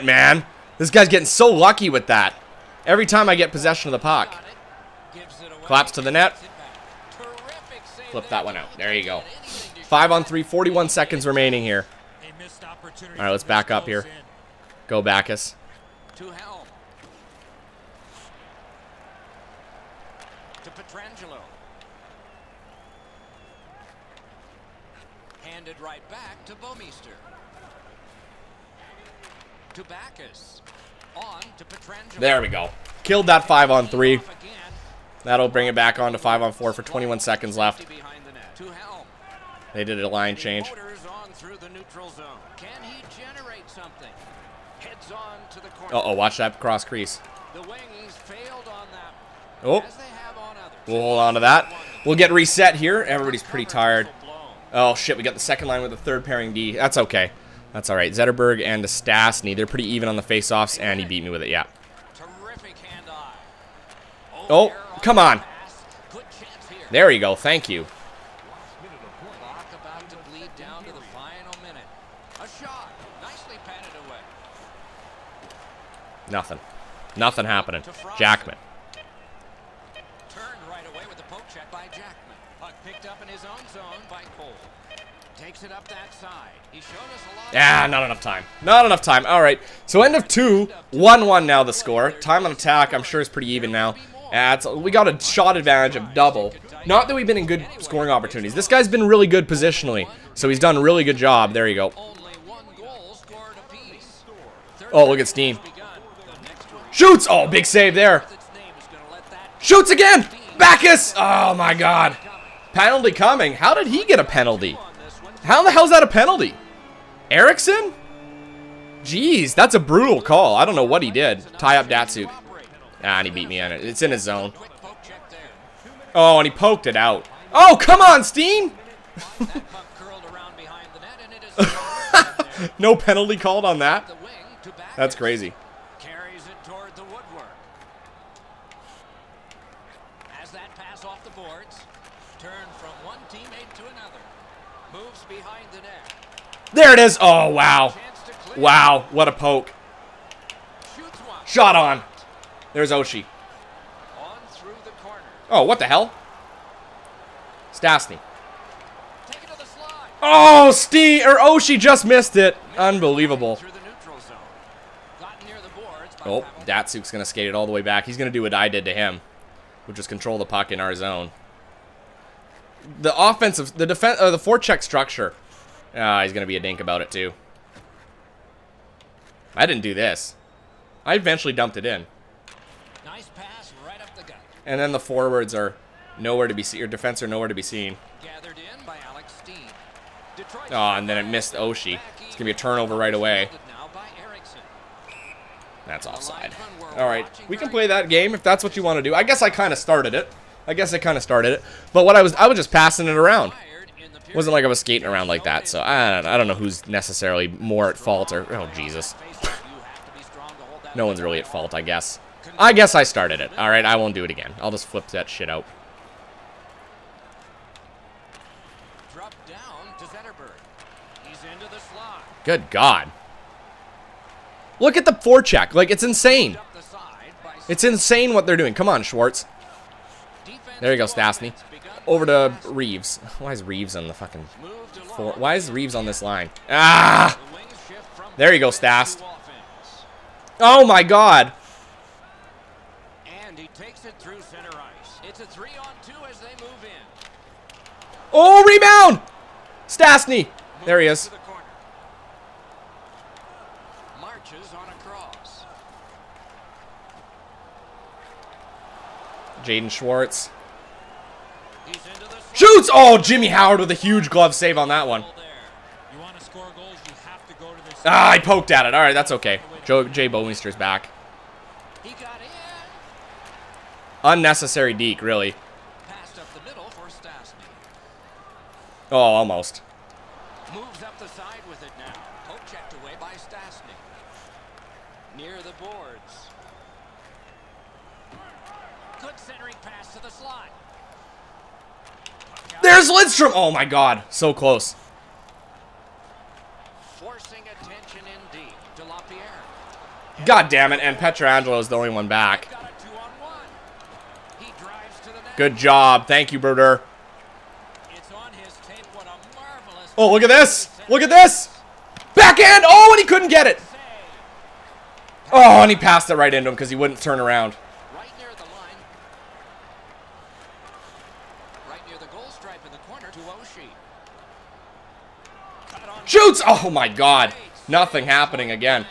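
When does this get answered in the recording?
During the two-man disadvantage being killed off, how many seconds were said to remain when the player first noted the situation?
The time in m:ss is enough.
0:10.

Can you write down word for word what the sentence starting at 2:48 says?
He's going to do what I did to him, which is control the puck in our zone.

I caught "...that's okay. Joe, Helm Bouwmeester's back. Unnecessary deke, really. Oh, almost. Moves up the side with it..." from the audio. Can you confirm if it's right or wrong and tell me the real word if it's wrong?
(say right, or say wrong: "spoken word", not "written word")
wrong: "Jay", not "Helm".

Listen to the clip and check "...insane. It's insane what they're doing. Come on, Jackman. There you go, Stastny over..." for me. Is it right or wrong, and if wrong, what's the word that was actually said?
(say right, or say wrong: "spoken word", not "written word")
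wrong: "Schwartz", not "Jackman".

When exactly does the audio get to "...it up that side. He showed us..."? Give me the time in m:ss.
1:25.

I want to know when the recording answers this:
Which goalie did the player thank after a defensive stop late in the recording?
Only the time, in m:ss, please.
5:06.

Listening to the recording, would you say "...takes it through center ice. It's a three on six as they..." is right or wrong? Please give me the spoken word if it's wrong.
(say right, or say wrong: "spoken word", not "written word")
wrong: "two", not "six".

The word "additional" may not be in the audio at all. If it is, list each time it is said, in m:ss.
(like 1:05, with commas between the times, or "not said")
not said.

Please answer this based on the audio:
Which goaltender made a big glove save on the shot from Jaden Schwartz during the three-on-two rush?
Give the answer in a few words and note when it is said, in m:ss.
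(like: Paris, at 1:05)
Jimmy Howard, at 4:23.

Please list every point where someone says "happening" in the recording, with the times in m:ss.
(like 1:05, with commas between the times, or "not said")
1:17, 5:28.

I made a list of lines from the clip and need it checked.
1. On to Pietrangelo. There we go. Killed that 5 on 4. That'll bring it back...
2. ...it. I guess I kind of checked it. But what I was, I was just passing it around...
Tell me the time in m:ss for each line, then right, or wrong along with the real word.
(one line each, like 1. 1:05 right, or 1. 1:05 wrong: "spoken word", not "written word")
1. 0:31 wrong: "3", not "4"
2. 3:20 wrong: "started", not "checked".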